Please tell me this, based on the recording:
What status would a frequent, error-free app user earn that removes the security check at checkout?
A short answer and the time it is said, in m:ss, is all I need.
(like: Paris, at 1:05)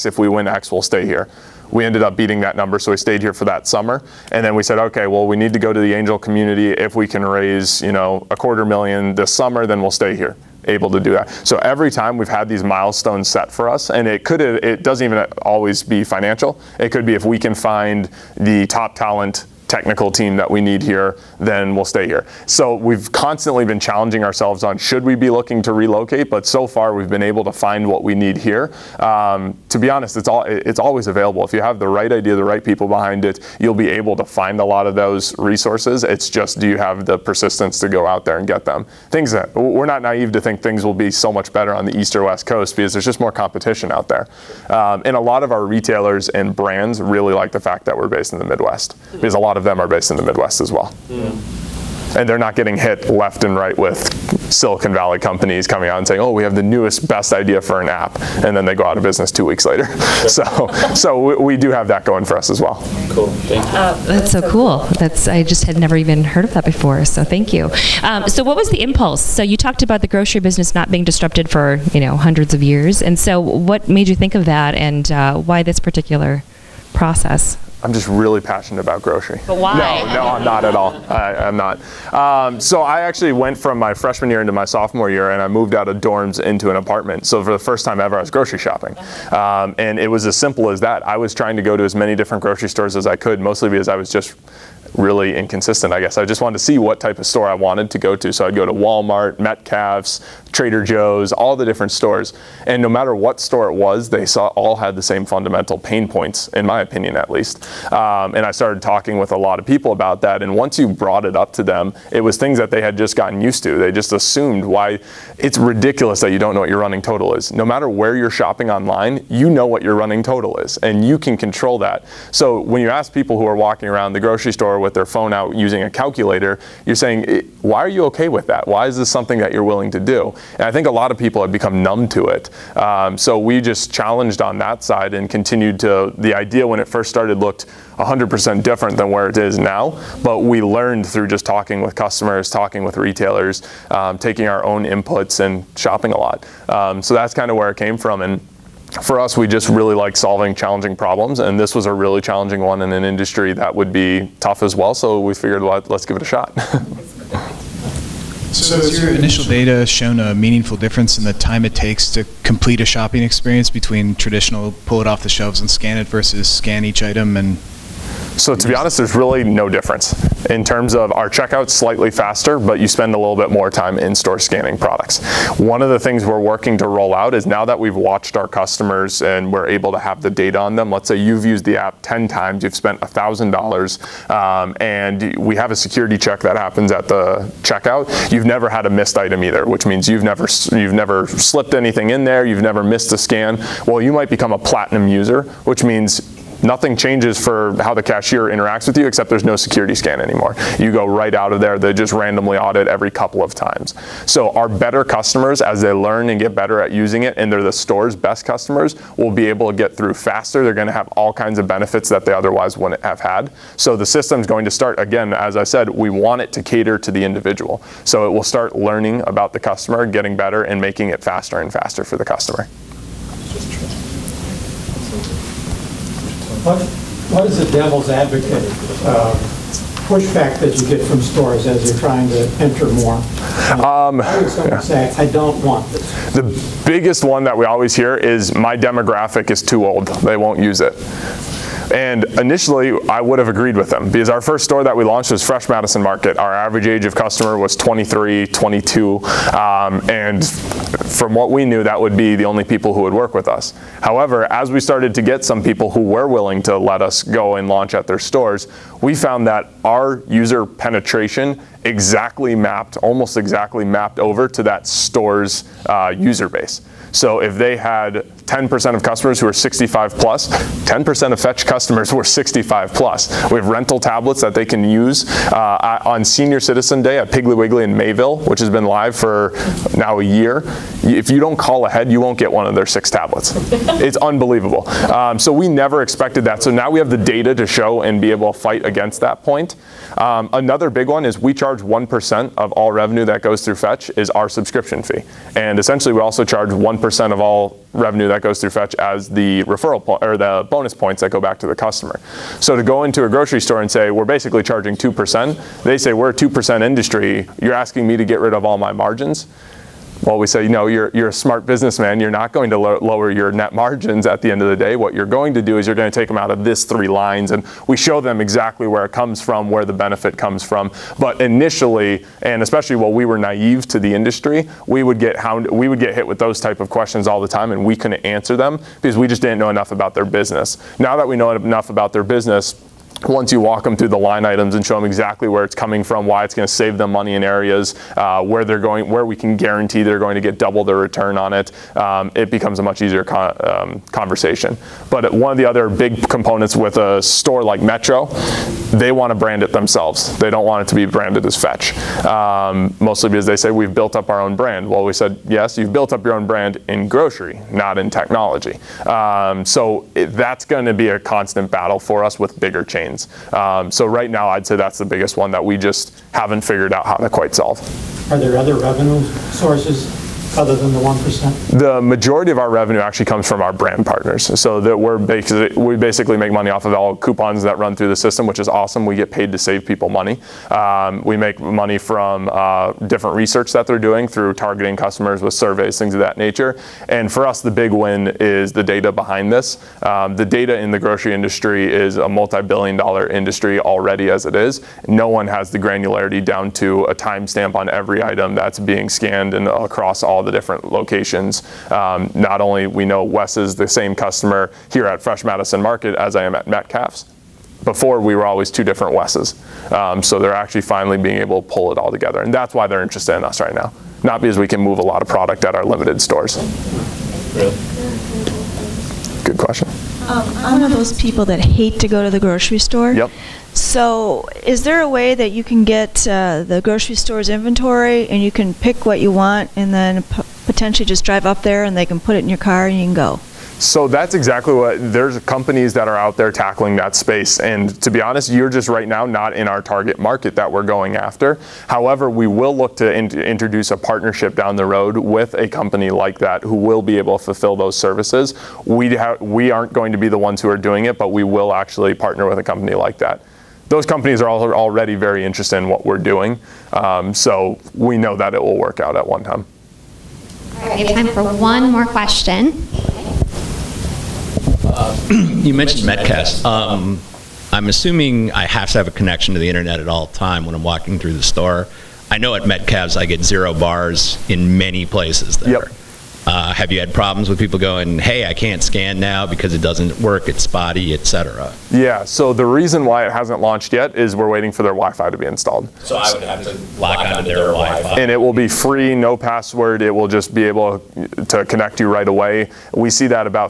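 platinum user, at 3:14.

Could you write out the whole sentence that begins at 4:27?
So if they had 10% of customers who are 65 plus, 10% of Fetch customers were 65 plus.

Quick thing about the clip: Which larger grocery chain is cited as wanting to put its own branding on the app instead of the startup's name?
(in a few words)
Metro.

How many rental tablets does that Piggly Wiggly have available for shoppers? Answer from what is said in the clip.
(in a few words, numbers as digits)
6.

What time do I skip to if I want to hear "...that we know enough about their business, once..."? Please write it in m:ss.
5:31.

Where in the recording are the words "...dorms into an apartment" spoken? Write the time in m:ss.
1:25.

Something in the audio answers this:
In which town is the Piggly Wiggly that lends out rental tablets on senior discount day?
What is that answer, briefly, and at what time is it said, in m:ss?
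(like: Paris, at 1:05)
Mayville, at 4:37.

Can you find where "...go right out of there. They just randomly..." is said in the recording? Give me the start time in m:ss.
3:20.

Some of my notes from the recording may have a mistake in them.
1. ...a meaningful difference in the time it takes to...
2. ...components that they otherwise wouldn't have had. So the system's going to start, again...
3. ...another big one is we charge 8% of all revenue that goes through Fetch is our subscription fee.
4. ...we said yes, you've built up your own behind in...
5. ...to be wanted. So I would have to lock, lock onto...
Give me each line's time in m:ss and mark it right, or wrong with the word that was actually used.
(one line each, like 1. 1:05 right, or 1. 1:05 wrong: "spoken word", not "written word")
1. 2:40 right
2. 3:31 wrong: "benefits", not "components"
3. 4:50 wrong: "1", not "8"
4. 5:55 wrong: "brand", not "behind"
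5. 8:05 wrong: "installed", not "wanted".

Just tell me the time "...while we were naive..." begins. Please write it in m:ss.
5:22.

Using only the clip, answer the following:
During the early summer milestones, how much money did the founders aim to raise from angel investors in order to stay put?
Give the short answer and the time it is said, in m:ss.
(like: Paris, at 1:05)
a quarter million, at 0:08.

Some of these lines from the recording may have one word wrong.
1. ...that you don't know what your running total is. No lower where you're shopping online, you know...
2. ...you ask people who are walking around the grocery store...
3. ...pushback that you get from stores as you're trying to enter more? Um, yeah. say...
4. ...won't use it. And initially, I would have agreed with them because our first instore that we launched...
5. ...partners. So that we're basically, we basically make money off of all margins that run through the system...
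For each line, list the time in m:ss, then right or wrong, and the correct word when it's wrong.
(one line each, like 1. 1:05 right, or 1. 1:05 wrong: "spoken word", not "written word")
1. 1:56 wrong: "matter", not "lower"
2. 2:02 right
3. 3:50 right
4. 4:00 wrong: "store", not "instore"
5. 6:14 wrong: "coupons", not "margins".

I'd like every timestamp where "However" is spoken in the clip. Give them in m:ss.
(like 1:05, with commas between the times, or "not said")
4:14, 7:21.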